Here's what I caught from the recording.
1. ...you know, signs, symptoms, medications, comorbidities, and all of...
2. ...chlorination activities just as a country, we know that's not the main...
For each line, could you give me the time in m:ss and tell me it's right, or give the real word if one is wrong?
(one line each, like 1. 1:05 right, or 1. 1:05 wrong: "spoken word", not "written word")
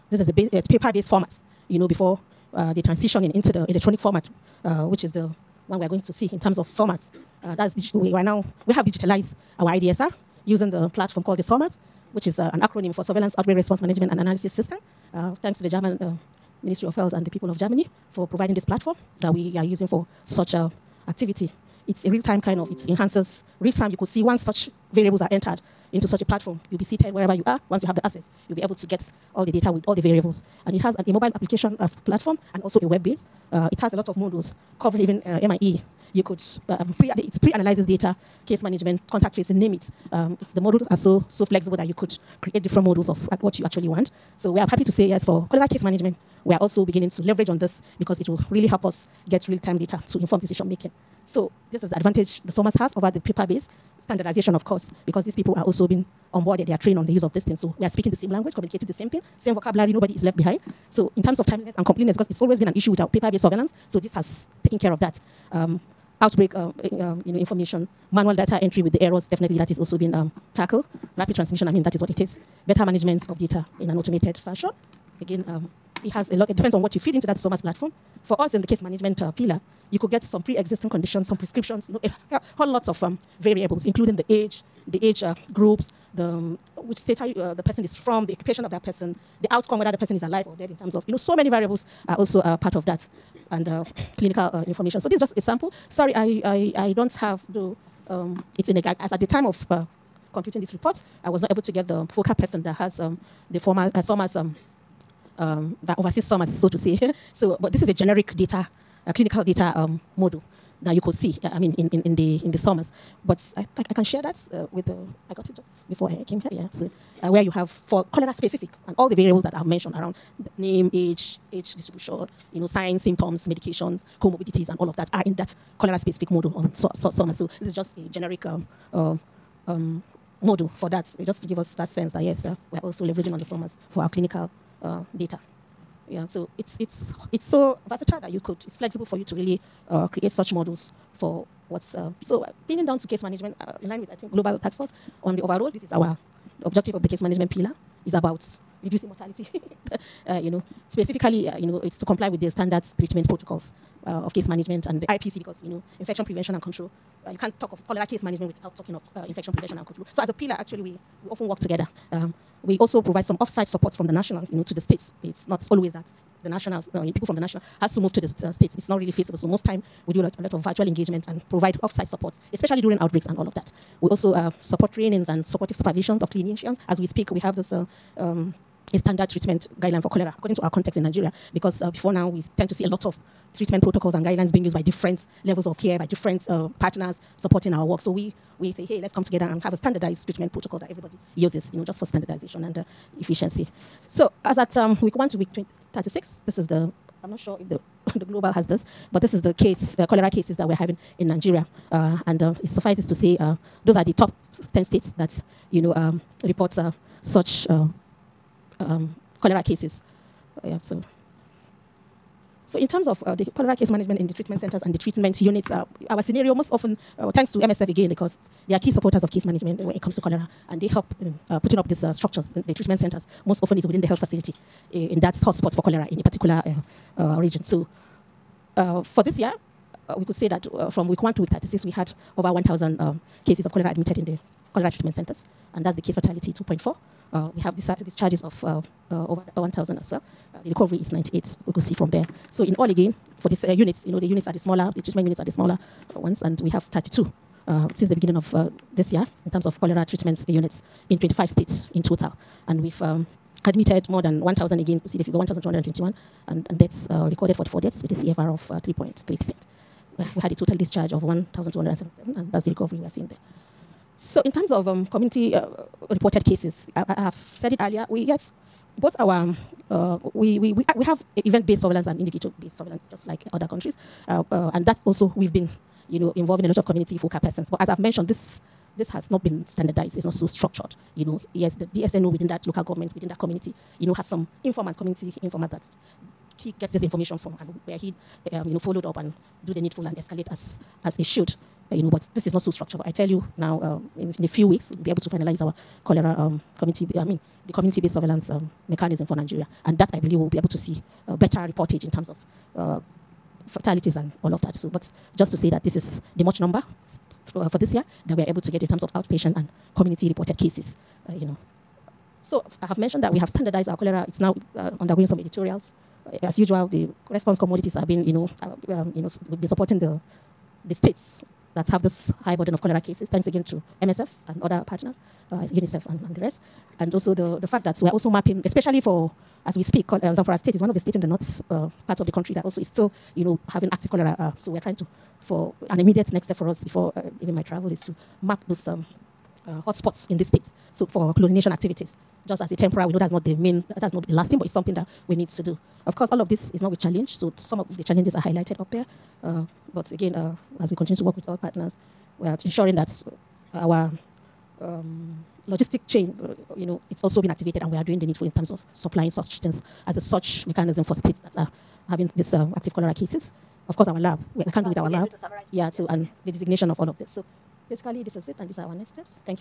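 1. 2:02 right
2. 5:41 wrong: "temporary", not "country".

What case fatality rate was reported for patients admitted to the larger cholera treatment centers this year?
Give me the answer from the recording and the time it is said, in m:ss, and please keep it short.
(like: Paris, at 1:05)
2.4, at 3:56.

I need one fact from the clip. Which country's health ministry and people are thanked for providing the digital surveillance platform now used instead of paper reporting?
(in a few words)
Germany.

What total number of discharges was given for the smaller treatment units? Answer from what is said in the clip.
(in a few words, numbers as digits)
1,207.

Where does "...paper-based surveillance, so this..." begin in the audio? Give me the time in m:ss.
1:03.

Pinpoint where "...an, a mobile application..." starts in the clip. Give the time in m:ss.
0:30.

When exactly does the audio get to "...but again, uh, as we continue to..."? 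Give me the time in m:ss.
5:49.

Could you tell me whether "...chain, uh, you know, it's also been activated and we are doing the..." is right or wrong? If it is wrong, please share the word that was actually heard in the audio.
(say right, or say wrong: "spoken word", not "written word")
right.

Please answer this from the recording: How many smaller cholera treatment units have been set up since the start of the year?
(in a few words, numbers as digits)
32.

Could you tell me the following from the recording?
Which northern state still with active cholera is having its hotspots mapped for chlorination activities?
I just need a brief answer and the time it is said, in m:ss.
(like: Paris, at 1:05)
Zamfara State, at 5:30.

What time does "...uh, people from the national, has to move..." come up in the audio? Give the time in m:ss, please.
2:46.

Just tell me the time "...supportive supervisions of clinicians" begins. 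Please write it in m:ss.
2:55.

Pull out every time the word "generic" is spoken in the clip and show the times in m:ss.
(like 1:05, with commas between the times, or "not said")
1:47, 2:08.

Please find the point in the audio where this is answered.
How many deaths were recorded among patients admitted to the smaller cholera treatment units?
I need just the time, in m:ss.
4:17.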